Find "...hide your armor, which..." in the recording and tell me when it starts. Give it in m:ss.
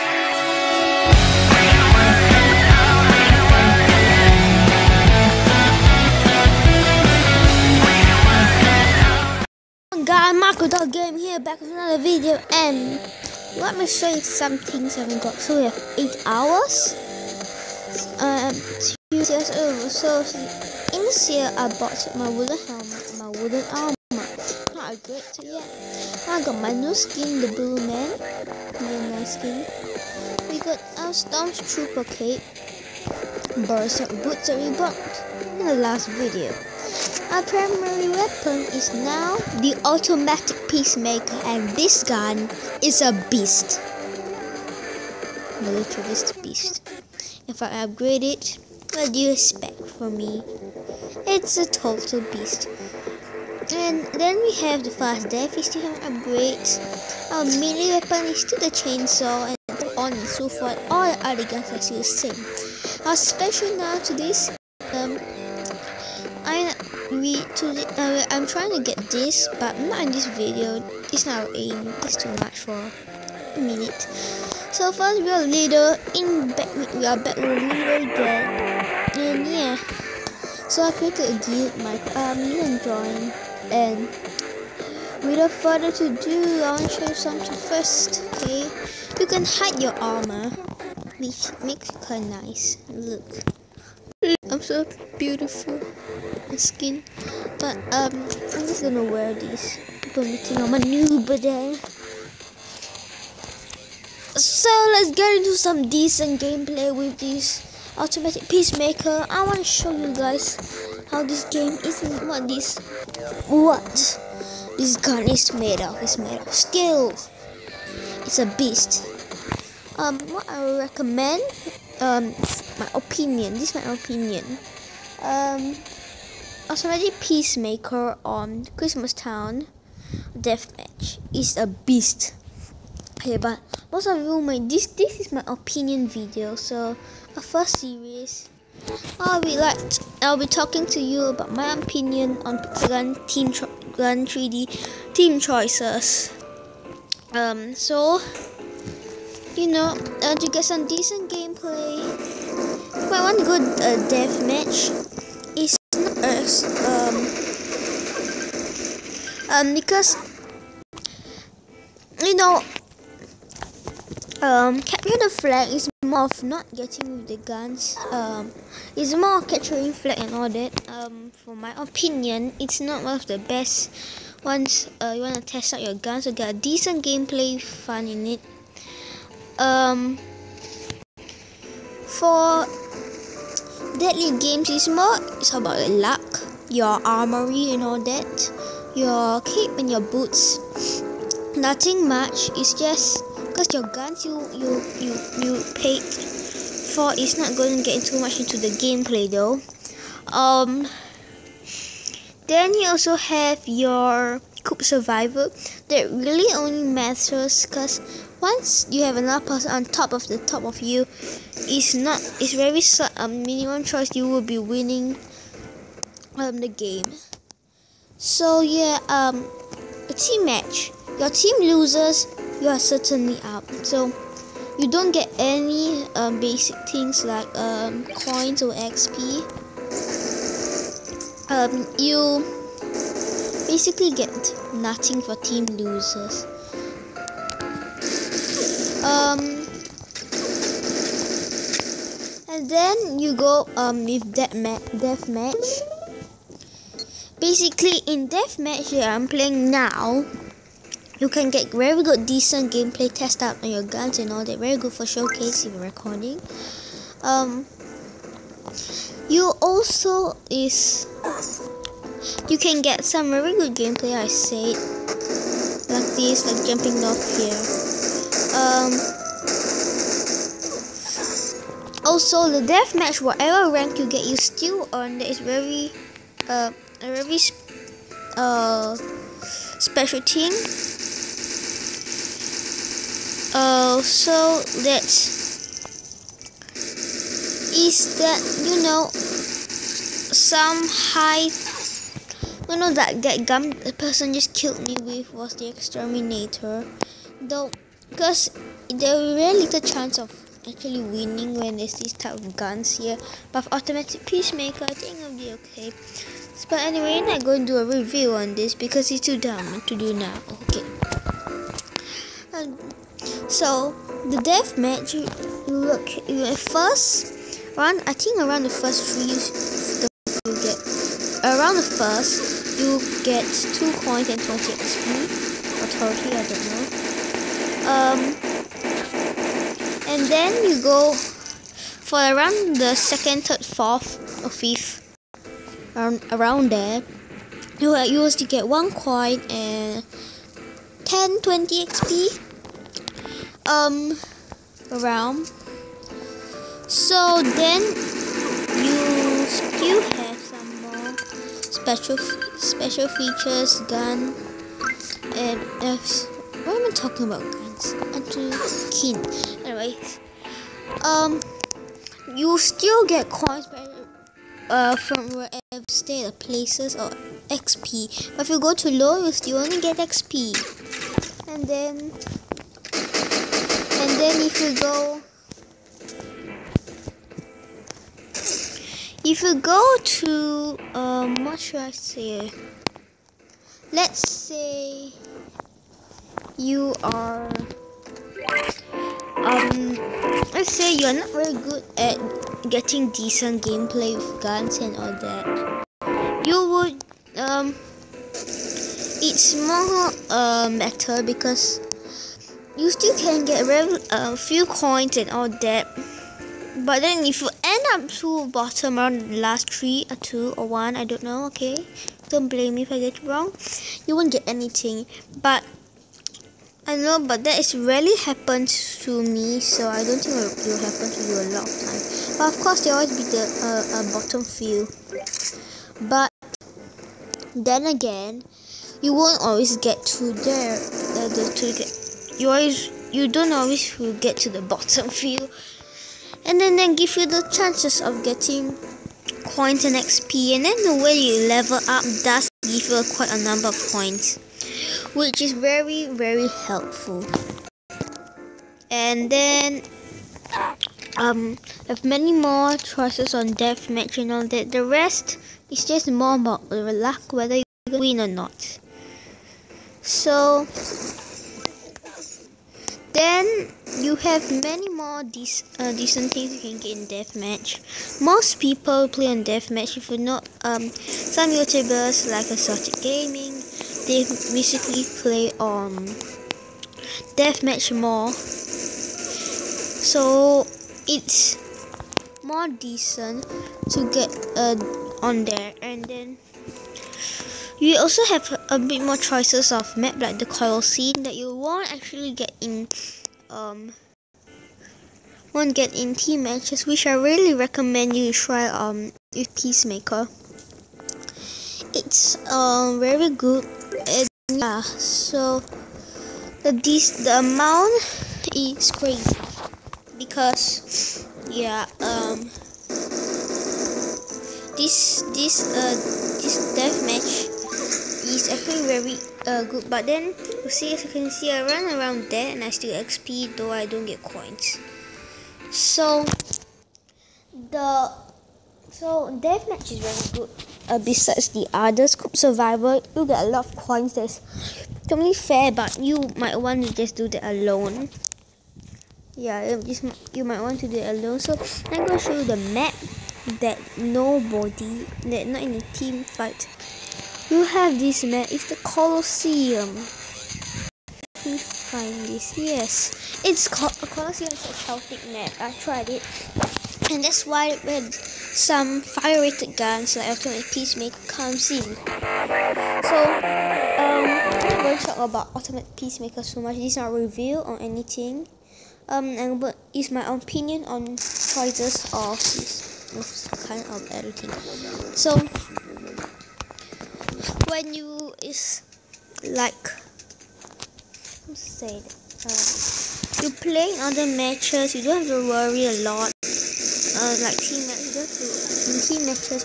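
1:29.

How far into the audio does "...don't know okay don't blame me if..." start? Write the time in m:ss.
6:51.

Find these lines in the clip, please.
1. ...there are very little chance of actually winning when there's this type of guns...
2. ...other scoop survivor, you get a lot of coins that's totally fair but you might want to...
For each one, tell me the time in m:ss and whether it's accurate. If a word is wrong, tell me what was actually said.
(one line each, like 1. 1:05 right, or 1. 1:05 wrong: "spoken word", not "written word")
1. 4:58 right
2. 8:51 right.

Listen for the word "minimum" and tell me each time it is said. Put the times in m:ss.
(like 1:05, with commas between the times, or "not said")
3:33.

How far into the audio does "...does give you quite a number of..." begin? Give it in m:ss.
7:22.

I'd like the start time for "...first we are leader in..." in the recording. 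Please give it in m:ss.
1:14.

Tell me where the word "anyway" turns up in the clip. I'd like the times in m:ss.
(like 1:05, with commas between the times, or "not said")
5:06.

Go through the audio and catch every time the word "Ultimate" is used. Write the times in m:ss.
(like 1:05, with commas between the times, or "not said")
9:25.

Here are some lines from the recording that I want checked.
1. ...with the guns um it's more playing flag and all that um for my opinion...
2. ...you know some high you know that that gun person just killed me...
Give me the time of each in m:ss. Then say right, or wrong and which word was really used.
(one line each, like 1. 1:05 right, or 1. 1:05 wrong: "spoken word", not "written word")
1. 2:47 wrong: "capturing", not "playing"
2. 4:48 right.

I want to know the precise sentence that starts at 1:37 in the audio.
But um, I'm just gonna wear these.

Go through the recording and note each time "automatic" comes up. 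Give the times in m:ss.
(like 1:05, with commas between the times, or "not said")
0:39, 1:47, 5:03, 9:20.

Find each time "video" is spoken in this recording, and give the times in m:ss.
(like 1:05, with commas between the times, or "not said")
0:11, 0:36, 1:10, 2:16.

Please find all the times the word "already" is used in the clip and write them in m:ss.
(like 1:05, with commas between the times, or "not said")
2:06.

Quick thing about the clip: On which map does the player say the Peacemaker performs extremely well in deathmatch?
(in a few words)
Christmas Town.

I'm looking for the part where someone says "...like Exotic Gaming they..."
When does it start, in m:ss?
7:52.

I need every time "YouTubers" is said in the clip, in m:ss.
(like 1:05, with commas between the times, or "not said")
7:51.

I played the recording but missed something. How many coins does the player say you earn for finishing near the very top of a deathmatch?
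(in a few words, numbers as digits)
2.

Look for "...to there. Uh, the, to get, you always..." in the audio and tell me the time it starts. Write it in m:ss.
7:10.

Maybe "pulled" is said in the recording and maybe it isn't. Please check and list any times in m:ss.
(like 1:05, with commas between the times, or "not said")
not said.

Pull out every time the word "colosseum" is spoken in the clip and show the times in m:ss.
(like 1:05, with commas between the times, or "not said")
8:10, 9:08, 9:14.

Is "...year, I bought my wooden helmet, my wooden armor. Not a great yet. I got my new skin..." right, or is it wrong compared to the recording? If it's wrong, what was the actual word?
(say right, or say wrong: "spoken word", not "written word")
right.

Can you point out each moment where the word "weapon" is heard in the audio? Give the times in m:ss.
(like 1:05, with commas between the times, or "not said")
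0:38, 0:57.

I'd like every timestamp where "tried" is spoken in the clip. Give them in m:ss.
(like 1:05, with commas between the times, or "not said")
9:15.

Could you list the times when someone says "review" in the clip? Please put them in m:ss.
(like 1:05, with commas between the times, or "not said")
5:07, 9:27.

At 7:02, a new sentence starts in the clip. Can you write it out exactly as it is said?
But of course, there always be the uh, bottom few.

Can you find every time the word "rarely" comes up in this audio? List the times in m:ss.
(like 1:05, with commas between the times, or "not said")
6:57.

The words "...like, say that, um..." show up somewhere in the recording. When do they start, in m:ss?
9:39.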